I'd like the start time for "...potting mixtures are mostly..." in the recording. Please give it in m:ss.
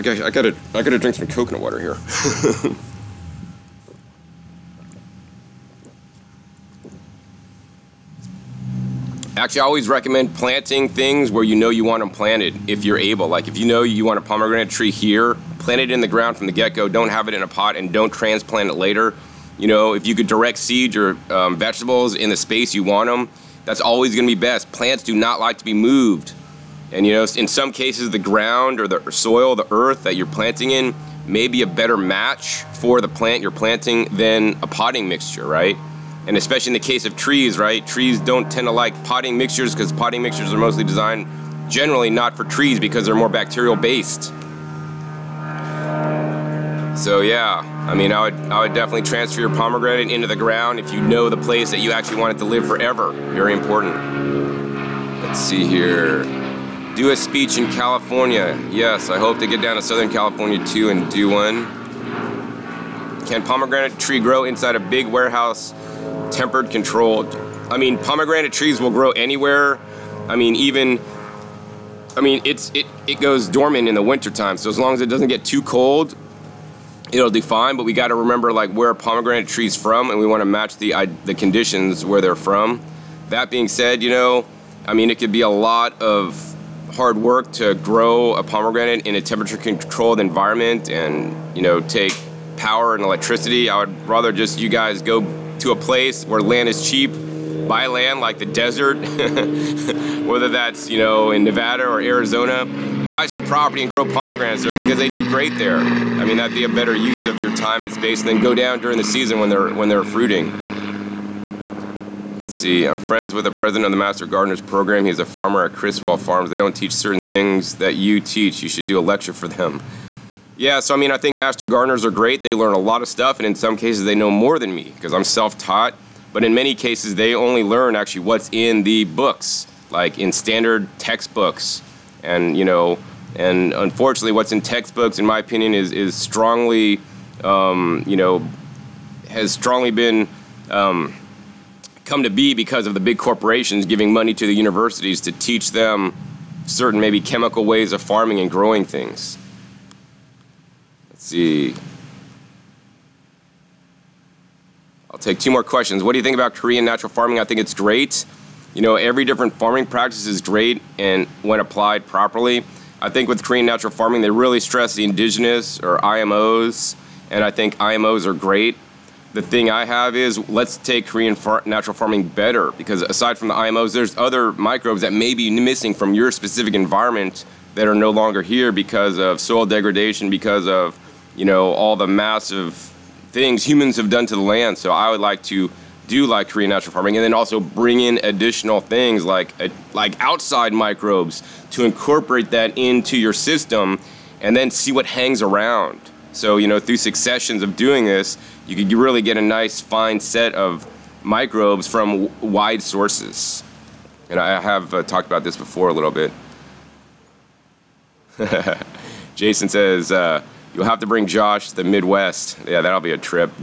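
0:39.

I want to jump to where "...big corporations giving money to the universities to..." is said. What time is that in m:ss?
2:23.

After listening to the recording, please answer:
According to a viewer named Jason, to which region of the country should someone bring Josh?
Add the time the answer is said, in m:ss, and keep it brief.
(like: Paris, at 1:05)
the Midwest, at 3:31.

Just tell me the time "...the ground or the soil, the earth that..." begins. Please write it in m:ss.
0:28.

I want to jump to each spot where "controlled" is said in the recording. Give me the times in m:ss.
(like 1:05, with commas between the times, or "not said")
1:06, 1:29.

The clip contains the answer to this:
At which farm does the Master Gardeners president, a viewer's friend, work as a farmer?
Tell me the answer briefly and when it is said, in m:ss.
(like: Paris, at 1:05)
Chriswell Farms, at 1:55.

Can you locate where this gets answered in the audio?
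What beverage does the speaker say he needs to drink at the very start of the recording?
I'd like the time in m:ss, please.
0:01.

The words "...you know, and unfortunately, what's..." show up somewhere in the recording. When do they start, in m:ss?
2:12.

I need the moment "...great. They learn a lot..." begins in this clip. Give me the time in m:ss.
2:02.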